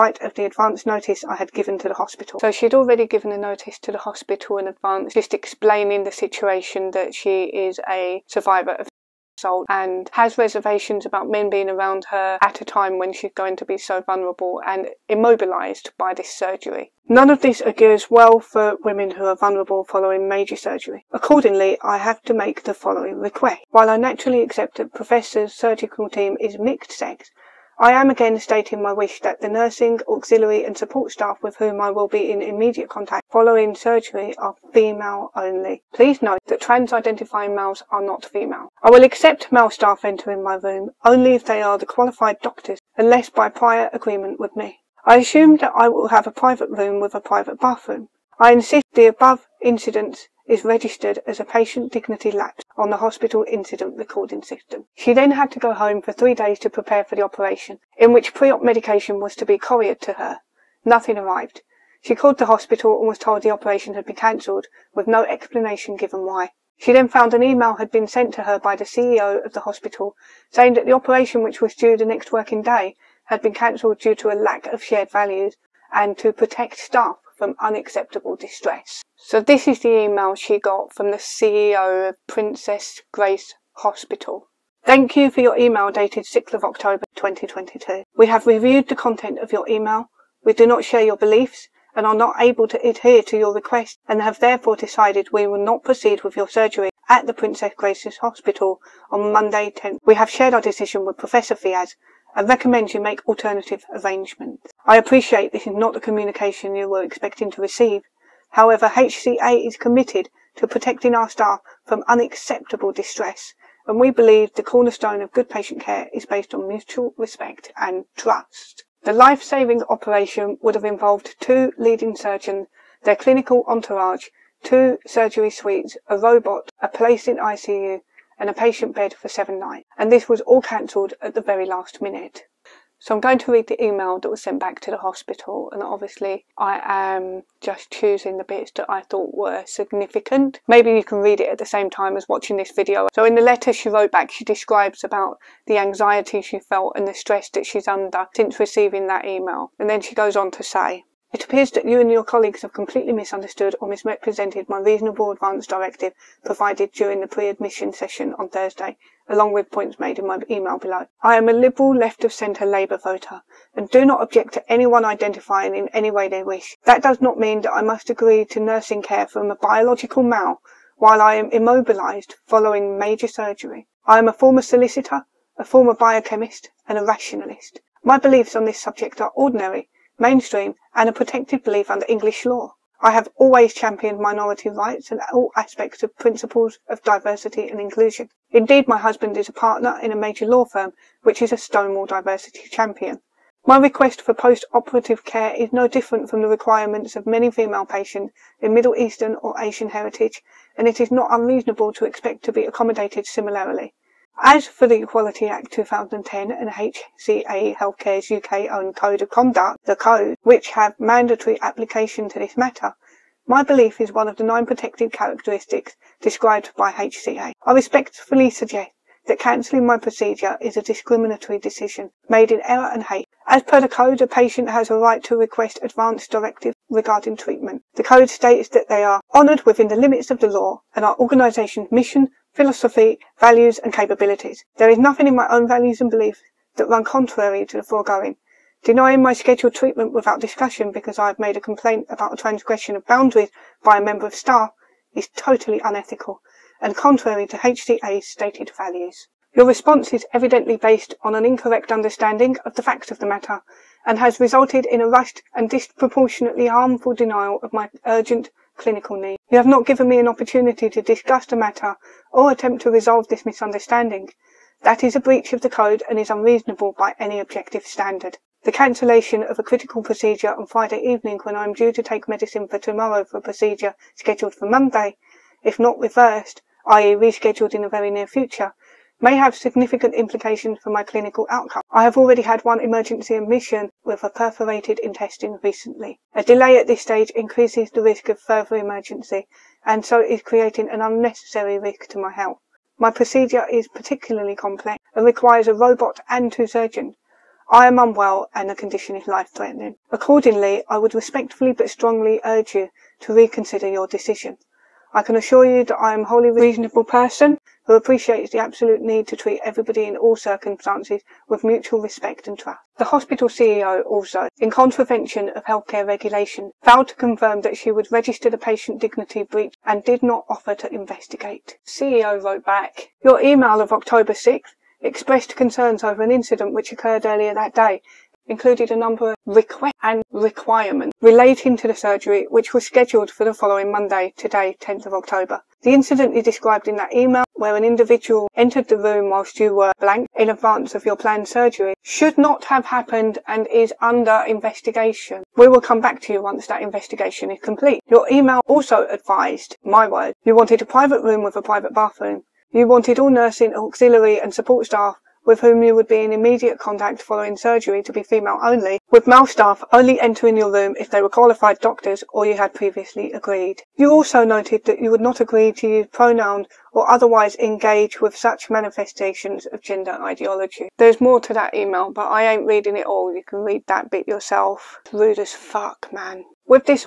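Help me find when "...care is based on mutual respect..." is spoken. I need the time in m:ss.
1:55.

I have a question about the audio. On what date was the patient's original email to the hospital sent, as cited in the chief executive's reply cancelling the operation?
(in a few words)
6 October 2022.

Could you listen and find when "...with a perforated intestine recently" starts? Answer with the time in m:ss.
4:44.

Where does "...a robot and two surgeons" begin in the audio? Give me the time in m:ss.
4:55.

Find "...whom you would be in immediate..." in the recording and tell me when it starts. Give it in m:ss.
5:55.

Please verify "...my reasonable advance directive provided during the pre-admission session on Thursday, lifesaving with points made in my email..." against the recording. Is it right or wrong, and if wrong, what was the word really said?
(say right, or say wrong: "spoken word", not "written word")
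wrong: "along", not "lifesaving".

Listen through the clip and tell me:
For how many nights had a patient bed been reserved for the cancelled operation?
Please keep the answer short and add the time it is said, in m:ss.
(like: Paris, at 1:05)
7, at 2:09.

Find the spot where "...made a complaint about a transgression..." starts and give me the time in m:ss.
4:01.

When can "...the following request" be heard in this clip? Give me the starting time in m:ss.
0:22.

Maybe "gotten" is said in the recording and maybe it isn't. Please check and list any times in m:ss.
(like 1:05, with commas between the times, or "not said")
not said.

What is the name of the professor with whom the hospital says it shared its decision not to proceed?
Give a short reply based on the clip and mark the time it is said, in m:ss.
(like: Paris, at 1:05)
Professor Fiaz, at 1:41.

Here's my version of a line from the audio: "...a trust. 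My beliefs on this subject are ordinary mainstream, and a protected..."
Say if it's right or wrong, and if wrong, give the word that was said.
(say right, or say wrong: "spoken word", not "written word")
wrong: "rationalist", not "trust".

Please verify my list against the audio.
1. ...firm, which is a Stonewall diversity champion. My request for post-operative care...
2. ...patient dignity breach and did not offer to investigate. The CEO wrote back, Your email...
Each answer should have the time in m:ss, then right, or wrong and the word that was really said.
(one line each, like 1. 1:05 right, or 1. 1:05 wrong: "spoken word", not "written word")
1. 3:10 right
2. 5:18 right.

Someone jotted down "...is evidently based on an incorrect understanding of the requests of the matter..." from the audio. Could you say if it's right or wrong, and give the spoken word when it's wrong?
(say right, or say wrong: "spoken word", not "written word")
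wrong: "facts", not "requests".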